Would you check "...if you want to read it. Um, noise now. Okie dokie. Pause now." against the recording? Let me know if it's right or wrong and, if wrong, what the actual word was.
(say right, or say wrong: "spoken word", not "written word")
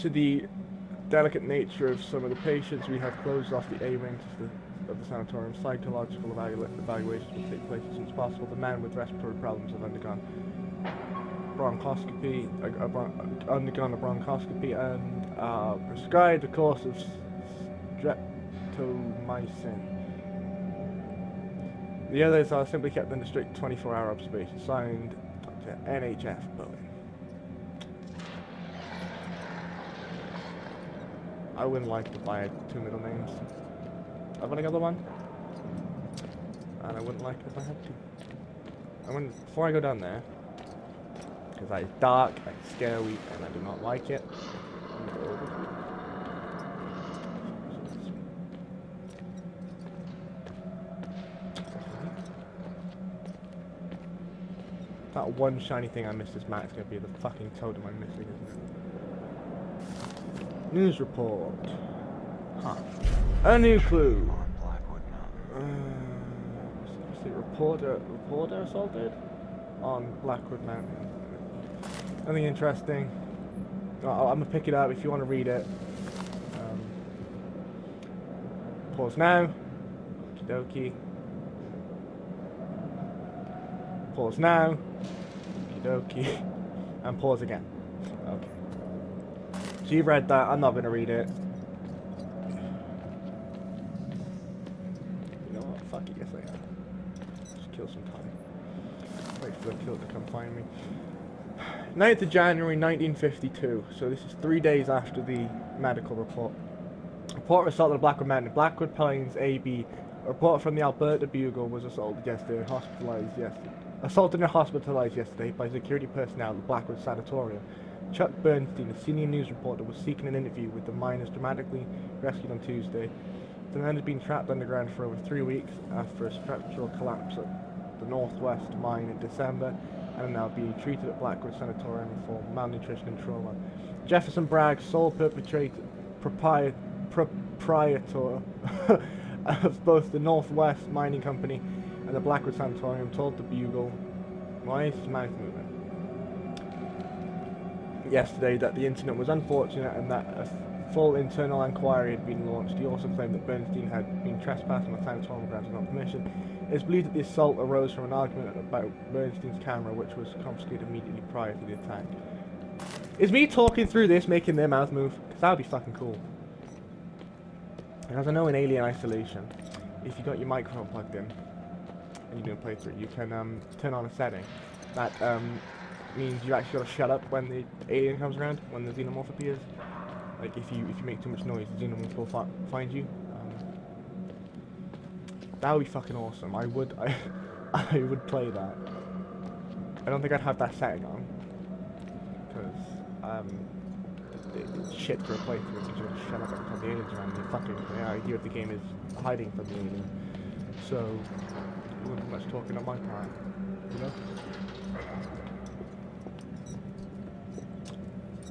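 wrong: "pause", not "noise".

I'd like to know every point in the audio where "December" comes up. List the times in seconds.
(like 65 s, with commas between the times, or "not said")
129 s.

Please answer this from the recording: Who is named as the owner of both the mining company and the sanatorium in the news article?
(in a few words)
Jefferson Bragg.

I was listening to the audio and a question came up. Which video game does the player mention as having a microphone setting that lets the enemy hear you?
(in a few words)
Alien Isolation.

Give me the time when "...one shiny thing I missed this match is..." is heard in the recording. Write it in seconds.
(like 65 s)
55 s.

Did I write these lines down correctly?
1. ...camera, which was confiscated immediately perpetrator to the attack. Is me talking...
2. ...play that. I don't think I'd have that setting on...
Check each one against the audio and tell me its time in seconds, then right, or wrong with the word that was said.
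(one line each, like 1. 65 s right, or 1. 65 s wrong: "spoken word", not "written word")
1. 159 s wrong: "prior", not "perpetrator"
2. 188 s right.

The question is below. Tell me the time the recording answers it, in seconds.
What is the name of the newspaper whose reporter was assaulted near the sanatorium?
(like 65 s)
110 s.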